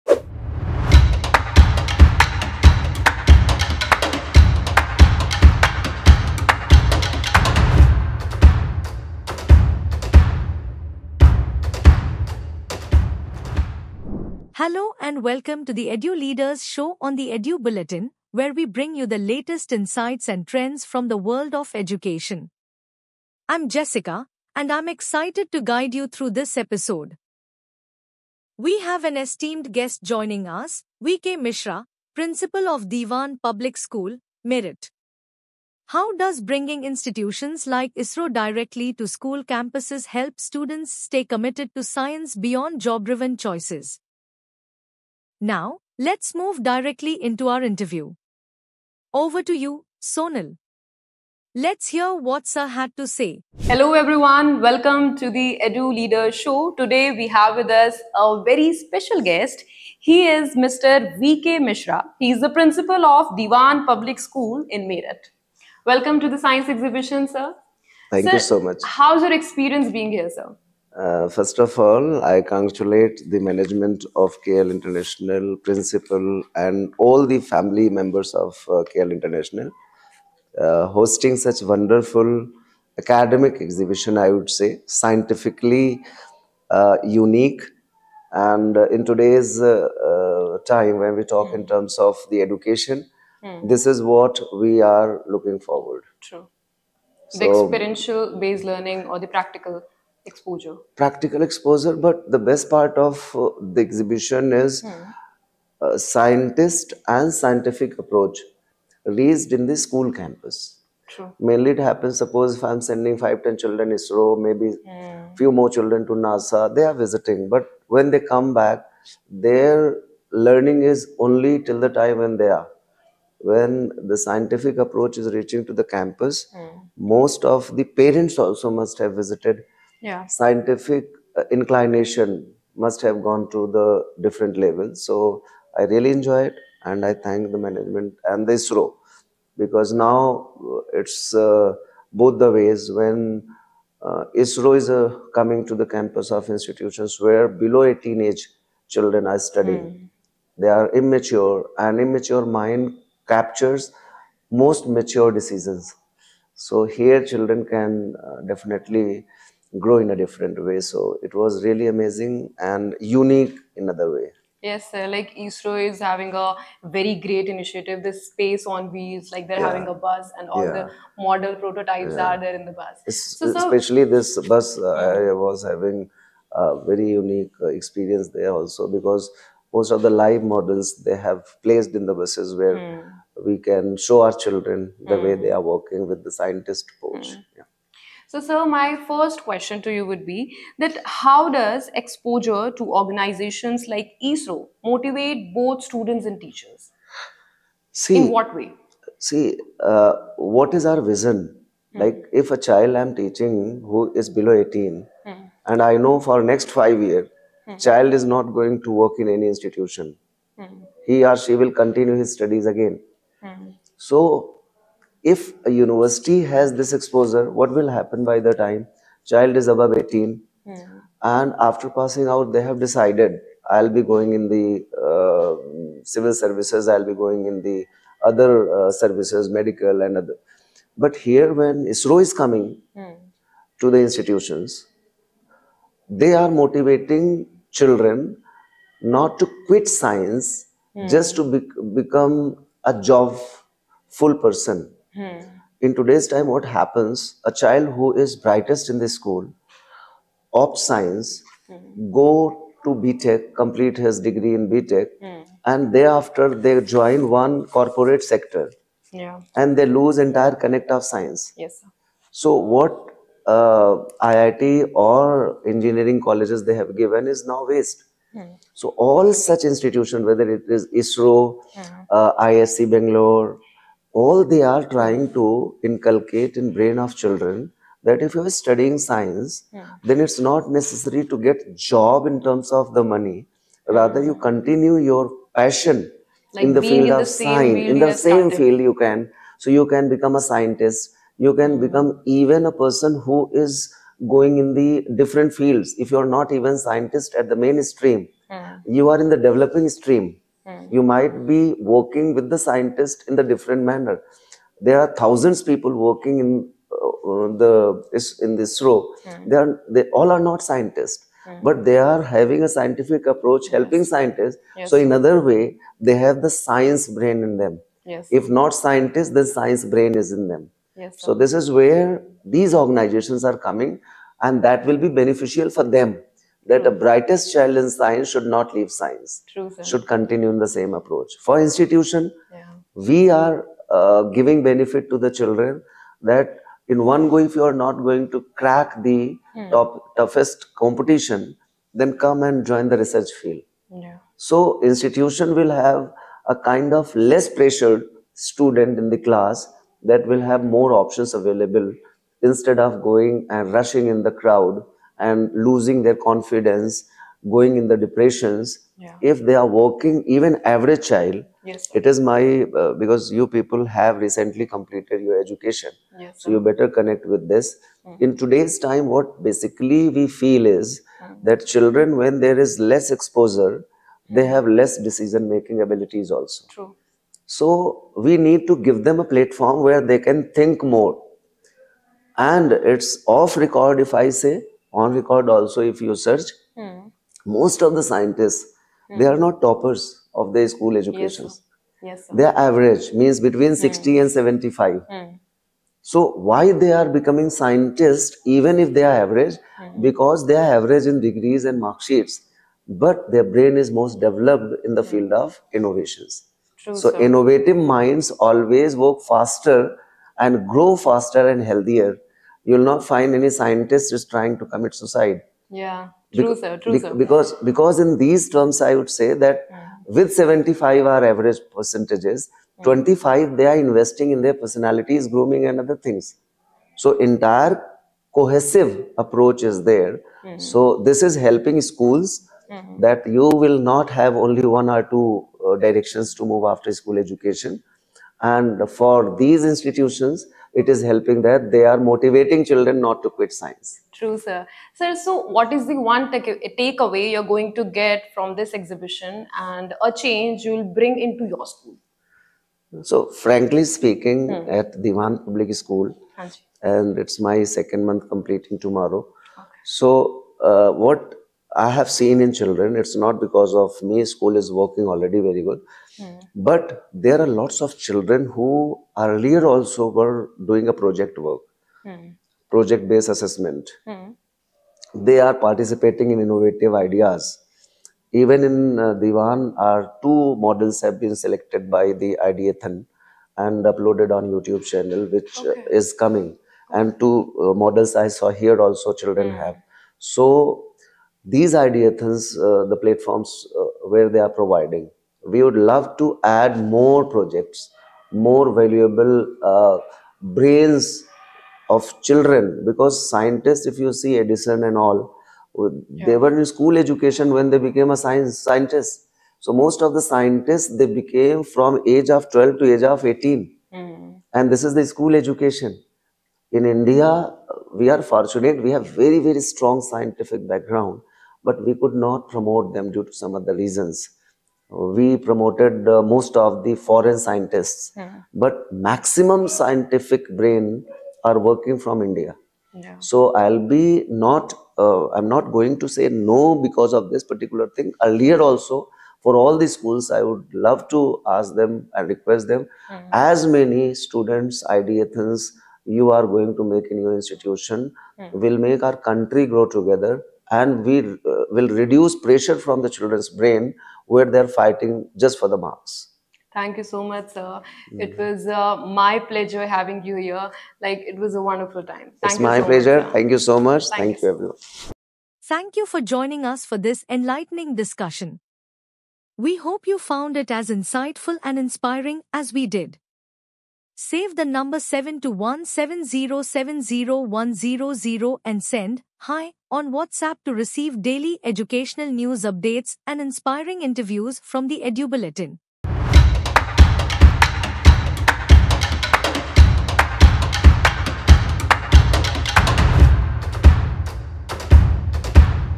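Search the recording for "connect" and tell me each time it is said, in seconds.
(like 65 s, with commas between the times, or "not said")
260 s, 366 s.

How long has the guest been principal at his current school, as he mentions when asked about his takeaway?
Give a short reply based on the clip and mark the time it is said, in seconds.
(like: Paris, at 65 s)
2 months, at 457 s.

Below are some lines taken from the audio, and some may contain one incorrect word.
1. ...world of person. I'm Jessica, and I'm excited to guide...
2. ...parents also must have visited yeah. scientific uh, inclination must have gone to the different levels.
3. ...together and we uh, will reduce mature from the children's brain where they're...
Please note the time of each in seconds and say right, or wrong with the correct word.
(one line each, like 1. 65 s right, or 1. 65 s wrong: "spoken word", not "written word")
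1. 21 s wrong: "education", not "person"
2. 127 s right
3. 549 s wrong: "pressure", not "mature".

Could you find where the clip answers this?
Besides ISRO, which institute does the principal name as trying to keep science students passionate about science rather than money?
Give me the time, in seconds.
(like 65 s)
272 s.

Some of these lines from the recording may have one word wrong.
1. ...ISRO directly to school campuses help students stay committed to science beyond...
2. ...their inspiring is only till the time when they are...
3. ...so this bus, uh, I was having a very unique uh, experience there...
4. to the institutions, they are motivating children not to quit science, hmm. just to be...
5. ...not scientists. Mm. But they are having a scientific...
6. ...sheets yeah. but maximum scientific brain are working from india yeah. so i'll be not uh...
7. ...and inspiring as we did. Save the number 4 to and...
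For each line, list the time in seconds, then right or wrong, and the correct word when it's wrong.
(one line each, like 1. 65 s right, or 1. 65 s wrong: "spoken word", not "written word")
1. 37 s right
2. 119 s wrong: "learning", not "inspiring"
3. 174 s right
4. 233 s right
5. 310 s right
6. 527 s wrong: "scientists", not "sheets"
7. 571 s wrong: "7", not "4".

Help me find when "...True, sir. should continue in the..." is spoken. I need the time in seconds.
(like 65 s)
329 s.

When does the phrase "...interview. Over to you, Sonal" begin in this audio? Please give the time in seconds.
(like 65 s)
47 s.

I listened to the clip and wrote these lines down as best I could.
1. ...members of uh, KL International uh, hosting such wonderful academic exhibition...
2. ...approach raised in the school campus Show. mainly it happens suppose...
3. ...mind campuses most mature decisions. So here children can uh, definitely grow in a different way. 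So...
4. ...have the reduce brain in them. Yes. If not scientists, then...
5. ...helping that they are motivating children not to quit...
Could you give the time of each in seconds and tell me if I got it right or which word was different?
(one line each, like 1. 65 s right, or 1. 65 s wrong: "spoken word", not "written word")
1. 77 s right
2. 107 s wrong: "True", not "Show"
3. 152 s wrong: "captures", not "campuses"
4. 316 s wrong: "science", not "reduce"
5. 441 s right.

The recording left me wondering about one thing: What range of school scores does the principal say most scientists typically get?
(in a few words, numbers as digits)
60 to 75.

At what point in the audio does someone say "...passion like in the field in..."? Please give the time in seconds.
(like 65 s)
285 s.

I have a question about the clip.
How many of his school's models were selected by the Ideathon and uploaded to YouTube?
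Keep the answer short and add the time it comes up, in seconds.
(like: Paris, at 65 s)
2, at 479 s.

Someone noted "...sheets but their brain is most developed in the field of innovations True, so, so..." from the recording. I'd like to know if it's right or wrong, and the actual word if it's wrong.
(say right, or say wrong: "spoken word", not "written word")
right.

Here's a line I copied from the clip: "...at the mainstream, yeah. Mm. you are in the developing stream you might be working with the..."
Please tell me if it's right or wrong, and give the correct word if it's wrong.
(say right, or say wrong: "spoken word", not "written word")
right.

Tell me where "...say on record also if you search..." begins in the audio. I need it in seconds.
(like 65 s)
384 s.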